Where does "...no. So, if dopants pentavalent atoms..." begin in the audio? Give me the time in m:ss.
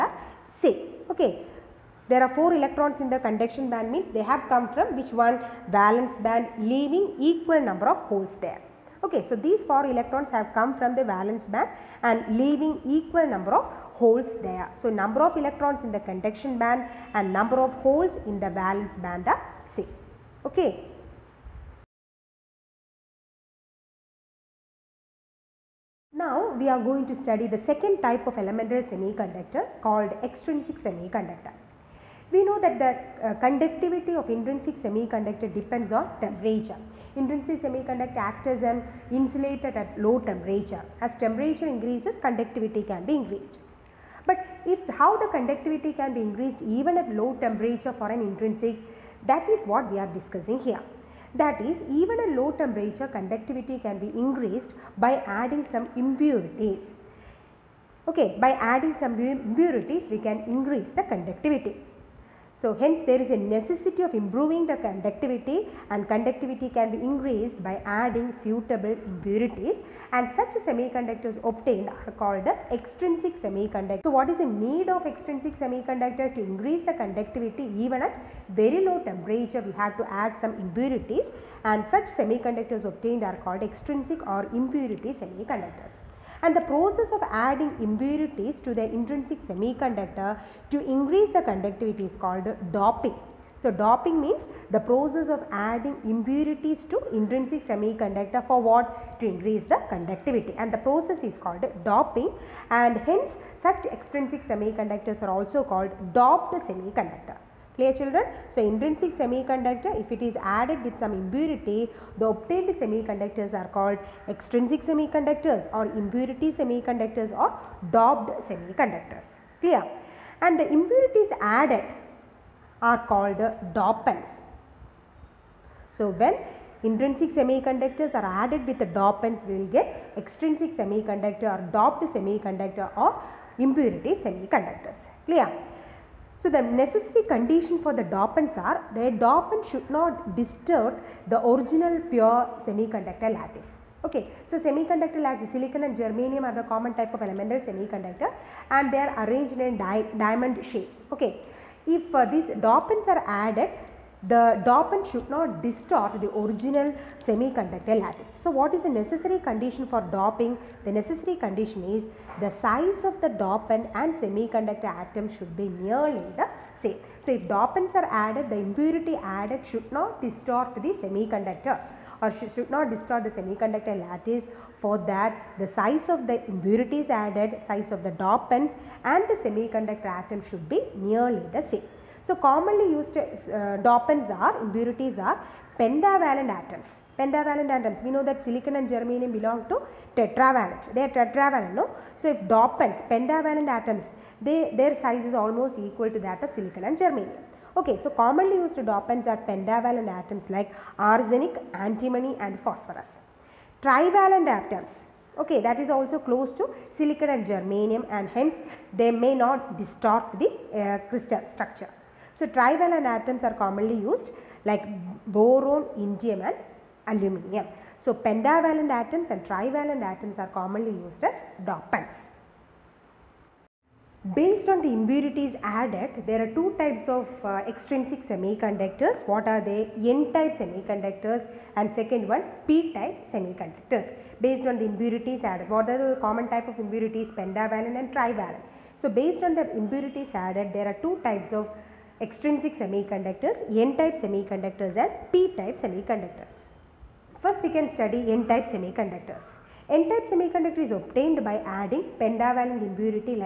3:11.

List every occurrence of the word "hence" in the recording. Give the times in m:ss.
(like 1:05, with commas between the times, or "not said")
1:02, 1:42, 3:28.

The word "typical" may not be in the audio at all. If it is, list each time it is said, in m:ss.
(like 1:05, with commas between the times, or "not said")
not said.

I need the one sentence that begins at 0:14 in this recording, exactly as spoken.
So, number of electrons in the conduction band and number of holes in the valence band are same.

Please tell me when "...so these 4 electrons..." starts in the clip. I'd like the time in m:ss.
0:09.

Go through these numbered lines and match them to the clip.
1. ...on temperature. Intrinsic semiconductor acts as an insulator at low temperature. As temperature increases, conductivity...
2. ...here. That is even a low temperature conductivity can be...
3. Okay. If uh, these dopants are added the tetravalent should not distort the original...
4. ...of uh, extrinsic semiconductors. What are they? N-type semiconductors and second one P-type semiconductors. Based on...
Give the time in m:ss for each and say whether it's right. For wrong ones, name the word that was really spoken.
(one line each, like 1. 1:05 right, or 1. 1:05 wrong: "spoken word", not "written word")
1. 0:35 right
2. 0:50 right
3. 2:31 wrong: "dopant", not "tetravalent"
4. 3:47 right.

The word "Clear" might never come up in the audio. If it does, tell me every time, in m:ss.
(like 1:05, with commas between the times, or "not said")
1:47, 1:59, 2:15.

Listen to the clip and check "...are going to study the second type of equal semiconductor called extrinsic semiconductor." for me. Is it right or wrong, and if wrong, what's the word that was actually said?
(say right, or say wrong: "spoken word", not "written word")
wrong: "elemental", not "equal".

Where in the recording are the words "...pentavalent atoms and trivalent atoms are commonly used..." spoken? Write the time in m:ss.
3:38.